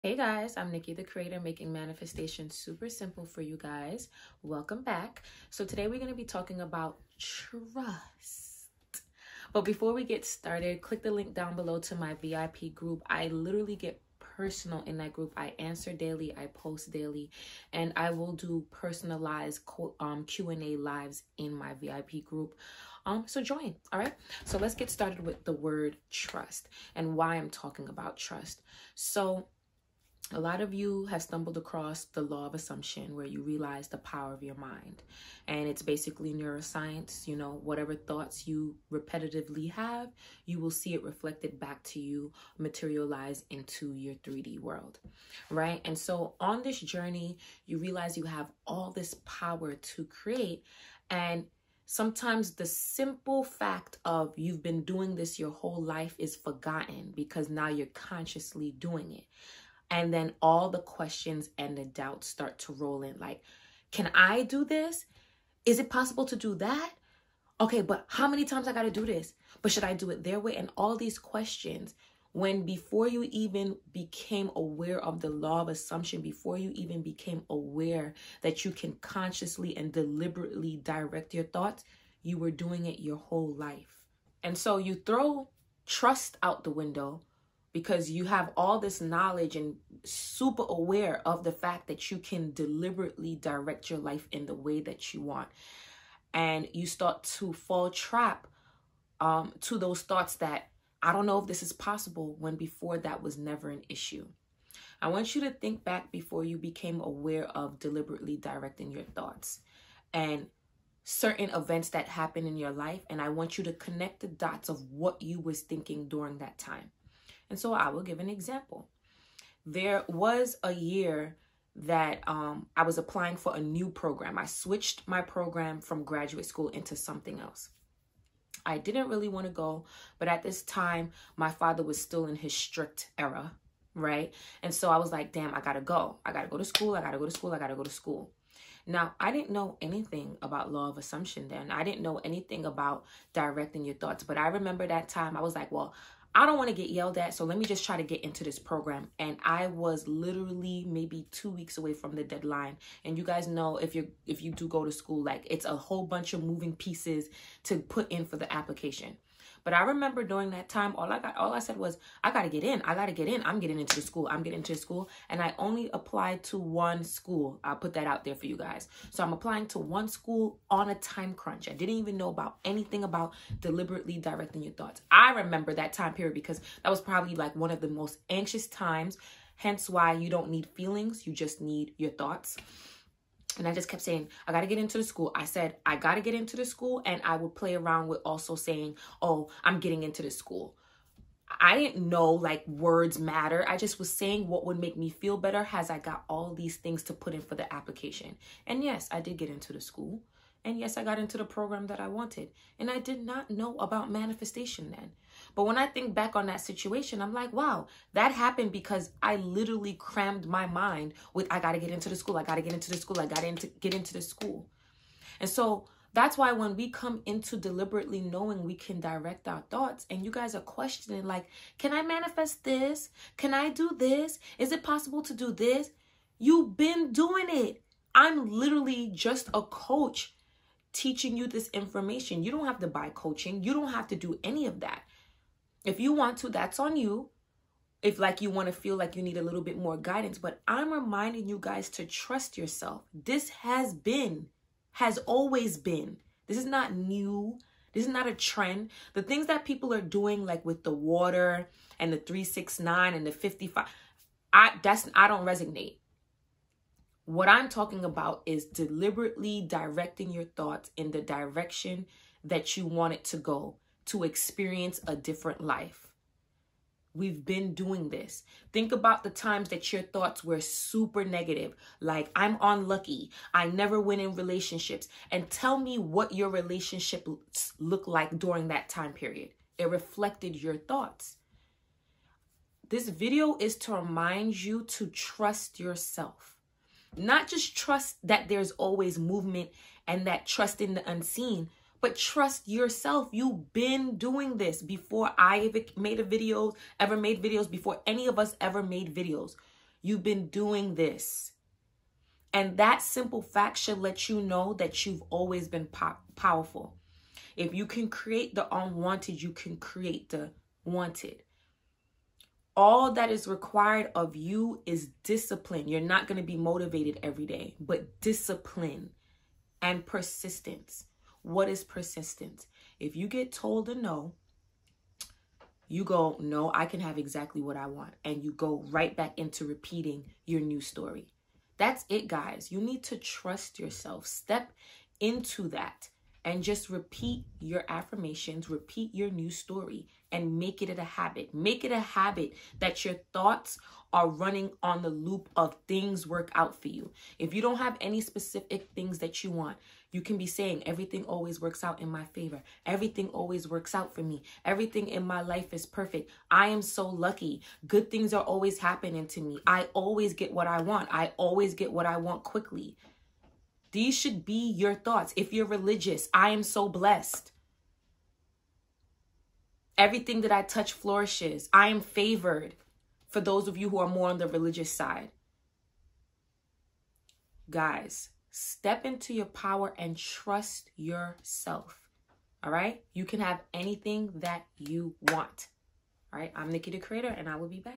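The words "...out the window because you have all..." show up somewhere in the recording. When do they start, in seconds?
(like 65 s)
86 s.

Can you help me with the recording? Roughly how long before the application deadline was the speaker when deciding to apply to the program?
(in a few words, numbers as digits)
2 weeks.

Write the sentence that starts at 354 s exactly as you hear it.
Everything in my life is perfect.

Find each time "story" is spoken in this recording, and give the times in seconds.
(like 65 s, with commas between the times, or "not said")
330 s, 339 s.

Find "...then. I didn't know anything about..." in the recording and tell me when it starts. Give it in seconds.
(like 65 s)
141 s.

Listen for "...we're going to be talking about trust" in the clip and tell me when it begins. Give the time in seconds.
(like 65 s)
5 s.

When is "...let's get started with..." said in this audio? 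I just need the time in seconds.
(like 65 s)
24 s.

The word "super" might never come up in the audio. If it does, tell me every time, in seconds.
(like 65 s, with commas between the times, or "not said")
2 s, 90 s, 270 s.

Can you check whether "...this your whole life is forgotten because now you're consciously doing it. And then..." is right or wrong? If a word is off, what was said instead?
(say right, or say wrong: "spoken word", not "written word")
right.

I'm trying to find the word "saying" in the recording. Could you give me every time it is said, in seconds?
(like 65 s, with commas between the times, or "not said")
184 s, 188 s, 194 s, 350 s.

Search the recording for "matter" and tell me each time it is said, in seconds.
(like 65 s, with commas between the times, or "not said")
193 s.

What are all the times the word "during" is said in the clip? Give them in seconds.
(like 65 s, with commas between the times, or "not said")
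116 s, 160 s, 278 s.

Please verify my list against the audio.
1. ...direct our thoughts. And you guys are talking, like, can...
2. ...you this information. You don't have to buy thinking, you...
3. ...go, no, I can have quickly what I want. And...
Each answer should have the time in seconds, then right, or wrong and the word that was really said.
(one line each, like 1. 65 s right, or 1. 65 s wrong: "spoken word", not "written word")
1. 219 s wrong: "questioning", not "talking"
2. 231 s wrong: "coaching", not "thinking"
3. 326 s wrong: "exactly", not "quickly".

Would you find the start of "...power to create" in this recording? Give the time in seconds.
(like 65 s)
49 s.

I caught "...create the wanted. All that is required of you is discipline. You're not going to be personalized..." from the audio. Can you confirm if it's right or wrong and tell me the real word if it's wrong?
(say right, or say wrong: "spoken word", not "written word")
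wrong: "motivated", not "personalized".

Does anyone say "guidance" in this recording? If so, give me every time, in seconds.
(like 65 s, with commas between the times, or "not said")
239 s.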